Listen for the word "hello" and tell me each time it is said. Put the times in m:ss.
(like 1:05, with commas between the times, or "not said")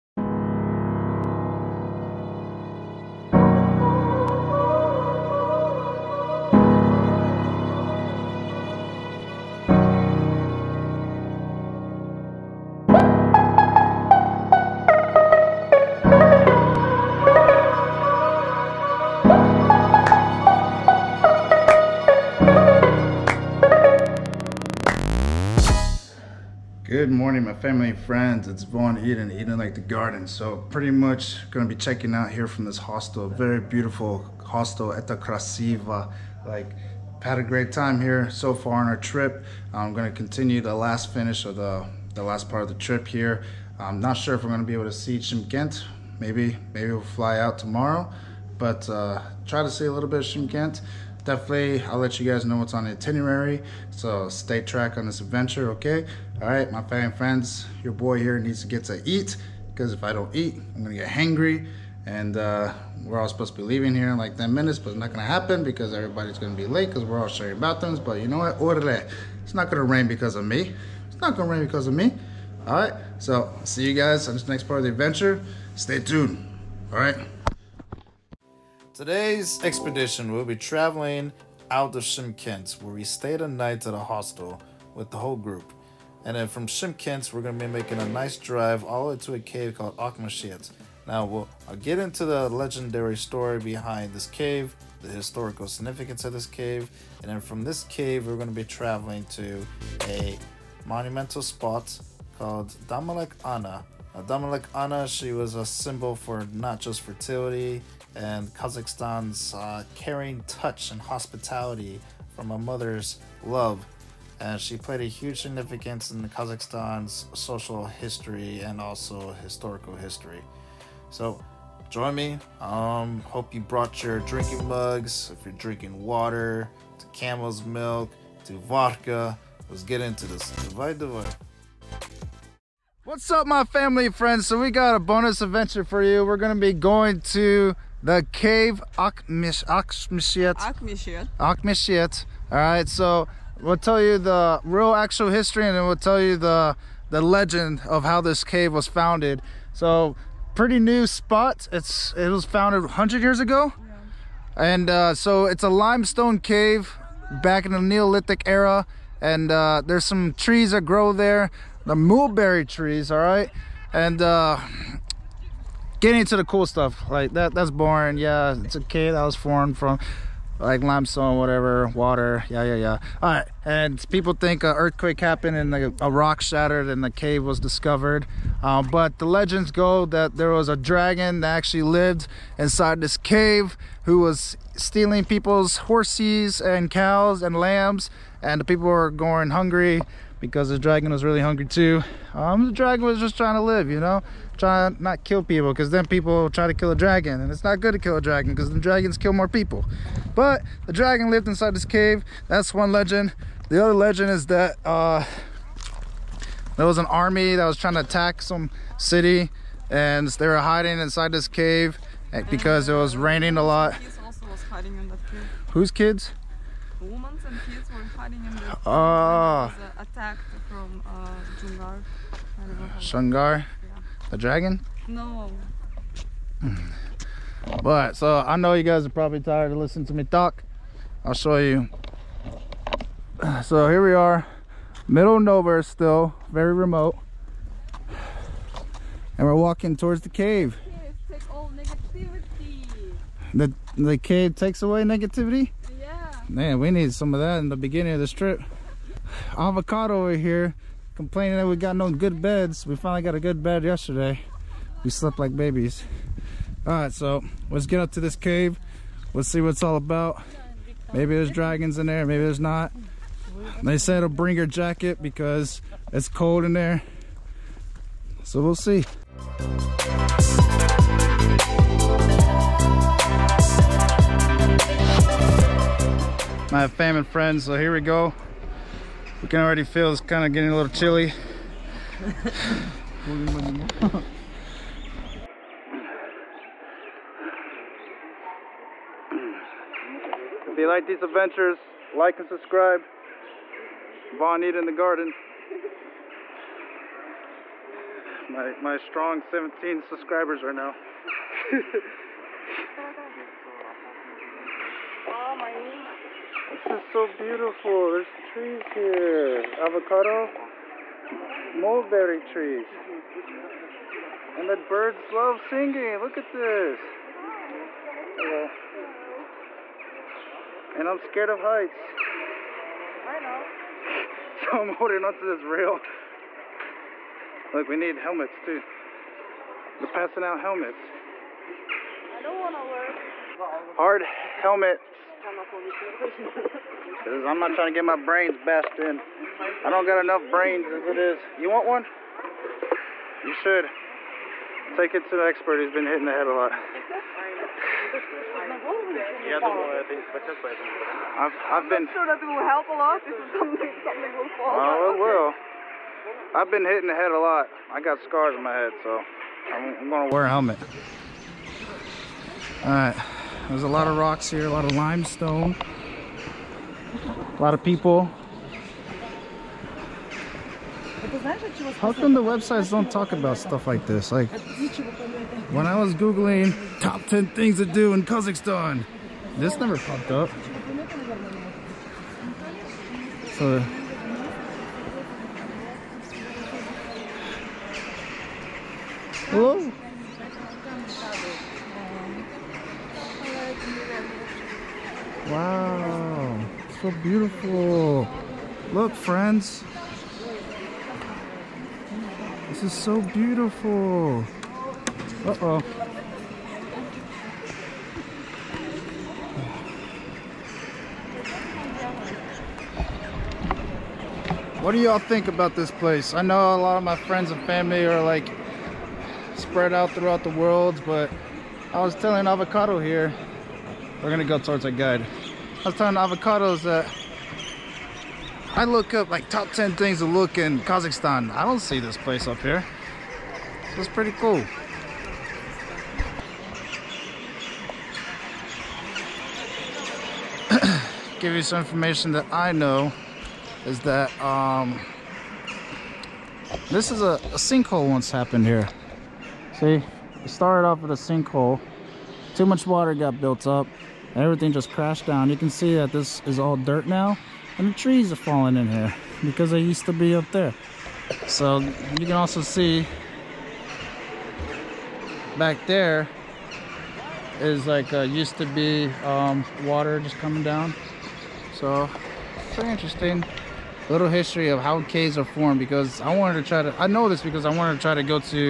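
5:18, 6:29.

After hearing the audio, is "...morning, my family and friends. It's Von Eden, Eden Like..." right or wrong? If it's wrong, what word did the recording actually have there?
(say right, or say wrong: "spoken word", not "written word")
right.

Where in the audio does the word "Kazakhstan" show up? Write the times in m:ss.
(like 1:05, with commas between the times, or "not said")
1:48, 1:56, 6:18, 7:10.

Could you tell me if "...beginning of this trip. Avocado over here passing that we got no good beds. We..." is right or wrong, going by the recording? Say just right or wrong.
wrong.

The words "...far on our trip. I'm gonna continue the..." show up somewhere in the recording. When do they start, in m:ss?
0:38.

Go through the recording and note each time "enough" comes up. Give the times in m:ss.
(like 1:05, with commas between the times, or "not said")
5:40.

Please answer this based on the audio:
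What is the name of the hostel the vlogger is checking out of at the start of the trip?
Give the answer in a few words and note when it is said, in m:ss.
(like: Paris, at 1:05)
Krasiva, at 0:35.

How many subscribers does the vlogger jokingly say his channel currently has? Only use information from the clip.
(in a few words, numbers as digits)
17.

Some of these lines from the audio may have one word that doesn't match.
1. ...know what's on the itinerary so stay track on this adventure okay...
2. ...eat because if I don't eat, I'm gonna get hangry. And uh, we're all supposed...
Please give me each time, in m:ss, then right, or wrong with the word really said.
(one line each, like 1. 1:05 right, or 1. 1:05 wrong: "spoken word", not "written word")
1. 0:52 right
2. 0:59 right.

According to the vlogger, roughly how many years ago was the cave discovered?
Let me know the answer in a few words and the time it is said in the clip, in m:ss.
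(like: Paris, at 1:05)
100 years, at 2:32.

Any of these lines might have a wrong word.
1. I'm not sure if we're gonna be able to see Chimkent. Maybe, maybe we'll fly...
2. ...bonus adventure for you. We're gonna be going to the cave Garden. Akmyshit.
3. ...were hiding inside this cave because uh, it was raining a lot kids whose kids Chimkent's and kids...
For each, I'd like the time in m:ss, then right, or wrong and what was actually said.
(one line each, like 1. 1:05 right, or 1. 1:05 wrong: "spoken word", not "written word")
1. 0:43 right
2. 2:14 wrong: "Akmyshit", not "Garden"
3. 3:30 wrong: "Women", not "Chimkent".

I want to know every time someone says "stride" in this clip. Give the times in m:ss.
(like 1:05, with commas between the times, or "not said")
not said.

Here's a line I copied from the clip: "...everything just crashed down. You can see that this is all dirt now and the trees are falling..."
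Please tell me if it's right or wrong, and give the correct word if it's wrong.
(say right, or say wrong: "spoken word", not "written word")
right.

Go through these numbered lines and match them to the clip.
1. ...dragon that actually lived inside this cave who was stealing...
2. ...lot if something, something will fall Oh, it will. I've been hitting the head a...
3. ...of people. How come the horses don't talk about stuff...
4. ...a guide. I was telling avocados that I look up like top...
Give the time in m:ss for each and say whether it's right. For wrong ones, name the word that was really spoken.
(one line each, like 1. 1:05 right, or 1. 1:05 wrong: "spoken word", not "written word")
1. 3:00 right
2. 5:52 right
3. 6:07 wrong: "websites", not "horses"
4. 7:04 right.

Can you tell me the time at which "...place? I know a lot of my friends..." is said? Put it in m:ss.
6:55.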